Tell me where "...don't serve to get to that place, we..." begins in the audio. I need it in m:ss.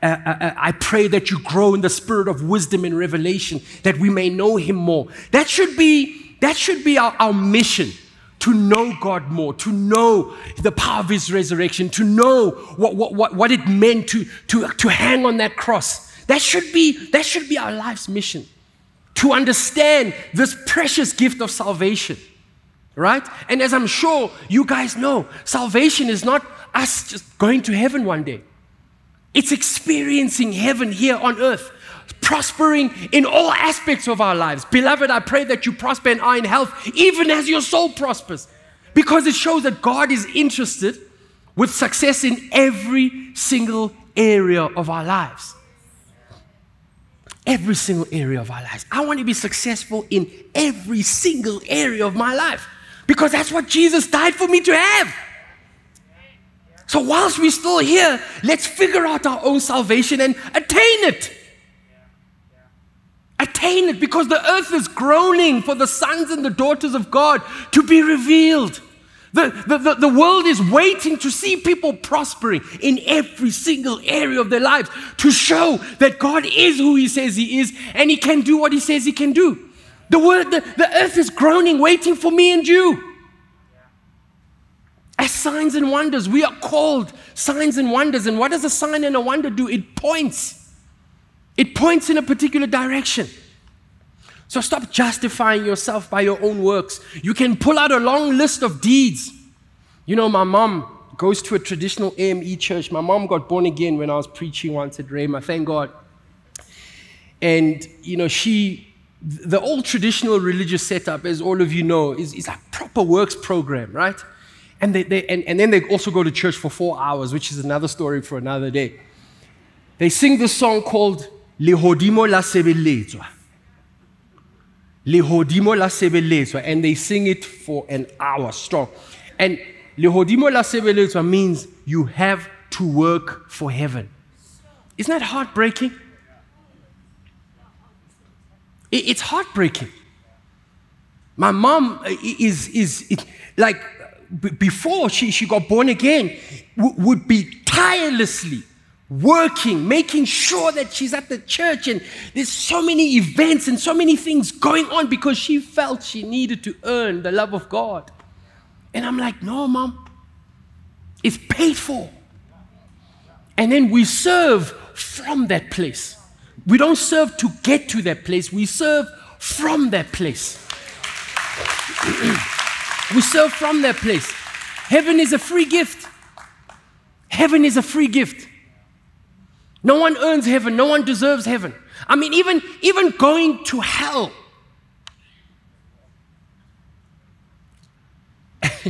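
2:46.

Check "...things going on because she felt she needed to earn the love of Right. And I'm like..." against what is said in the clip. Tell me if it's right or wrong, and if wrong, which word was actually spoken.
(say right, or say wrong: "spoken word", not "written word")
wrong: "God", not "Right".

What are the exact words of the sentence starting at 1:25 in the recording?
As signs and wonders, we are called signs and wonders.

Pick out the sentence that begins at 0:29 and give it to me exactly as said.
It's experiencing heaven here on earth, prospering in all aspects of our lives.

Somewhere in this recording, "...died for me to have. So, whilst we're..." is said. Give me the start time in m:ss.
0:54.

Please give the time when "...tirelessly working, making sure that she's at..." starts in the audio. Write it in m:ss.
2:27.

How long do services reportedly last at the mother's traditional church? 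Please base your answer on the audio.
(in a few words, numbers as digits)
4 hours.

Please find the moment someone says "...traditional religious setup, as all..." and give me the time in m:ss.
1:49.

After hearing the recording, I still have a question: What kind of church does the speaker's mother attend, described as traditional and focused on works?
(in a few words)
AME.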